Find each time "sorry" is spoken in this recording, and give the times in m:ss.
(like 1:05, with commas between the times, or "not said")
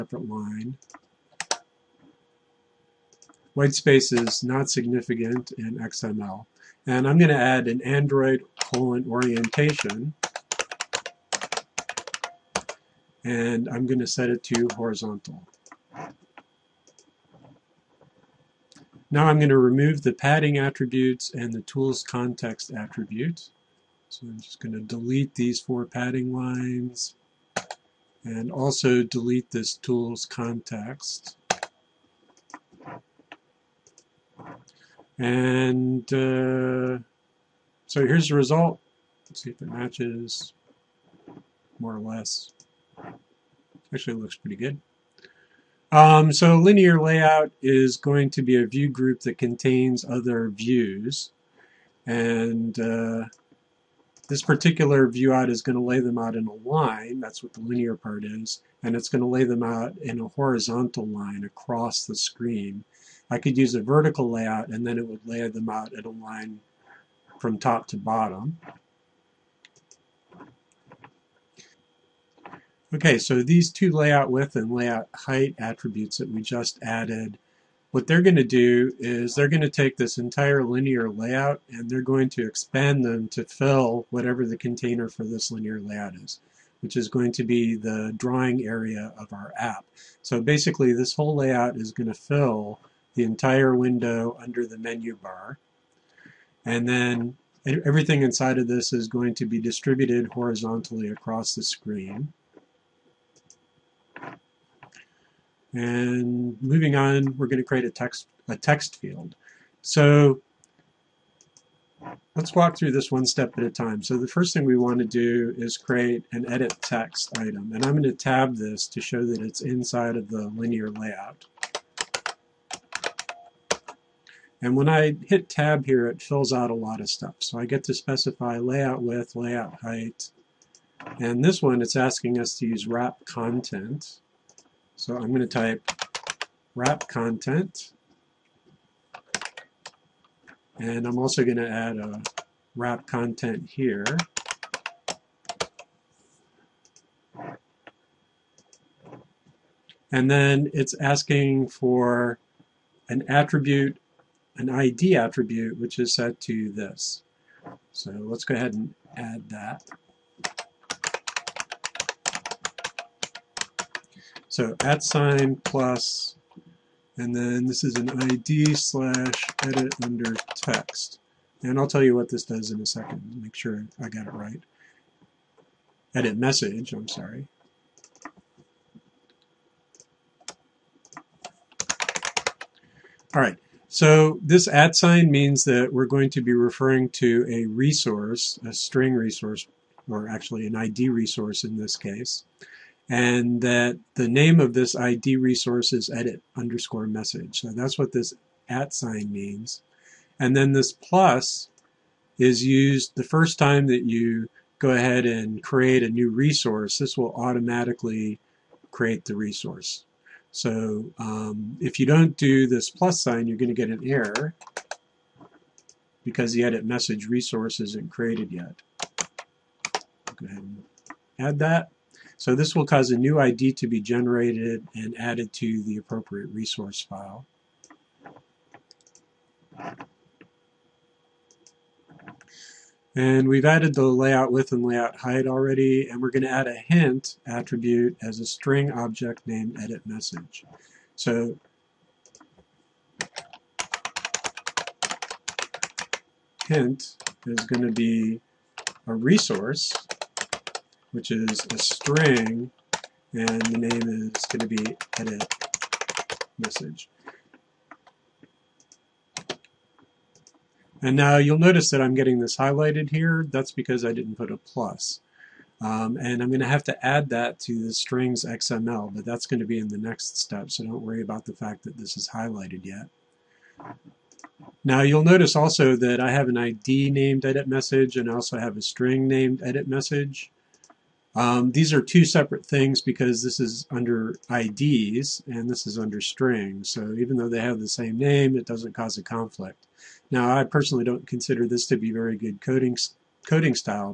2:57.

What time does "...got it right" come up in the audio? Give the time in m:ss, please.
2:54.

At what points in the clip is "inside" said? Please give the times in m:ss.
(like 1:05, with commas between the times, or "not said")
1:38, 1:59.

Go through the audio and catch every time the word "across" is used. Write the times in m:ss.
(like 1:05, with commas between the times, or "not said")
1:01, 1:41.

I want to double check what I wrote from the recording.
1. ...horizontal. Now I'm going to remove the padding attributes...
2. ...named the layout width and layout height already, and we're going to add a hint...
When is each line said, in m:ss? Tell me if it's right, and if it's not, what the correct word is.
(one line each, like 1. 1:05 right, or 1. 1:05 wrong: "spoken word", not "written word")
1. 0:14 right
2. 3:53 wrong: "added", not "named".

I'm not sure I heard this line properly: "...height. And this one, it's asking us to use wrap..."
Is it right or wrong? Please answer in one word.
right.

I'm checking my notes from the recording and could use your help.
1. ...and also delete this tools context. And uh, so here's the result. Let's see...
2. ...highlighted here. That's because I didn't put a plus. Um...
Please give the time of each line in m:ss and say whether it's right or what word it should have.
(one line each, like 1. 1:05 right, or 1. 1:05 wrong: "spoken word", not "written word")
1. 0:28 right
2. 4:22 right.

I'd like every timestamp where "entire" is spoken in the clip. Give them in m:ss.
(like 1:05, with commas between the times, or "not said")
1:20, 1:33.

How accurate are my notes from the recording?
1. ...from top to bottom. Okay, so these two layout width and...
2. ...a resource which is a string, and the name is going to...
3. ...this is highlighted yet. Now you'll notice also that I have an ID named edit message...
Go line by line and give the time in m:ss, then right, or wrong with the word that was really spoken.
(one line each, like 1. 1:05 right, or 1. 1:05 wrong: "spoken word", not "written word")
1. 1:07 right
2. 4:09 right
3. 4:31 right.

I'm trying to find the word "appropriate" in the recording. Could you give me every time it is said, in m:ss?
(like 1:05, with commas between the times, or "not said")
3:45.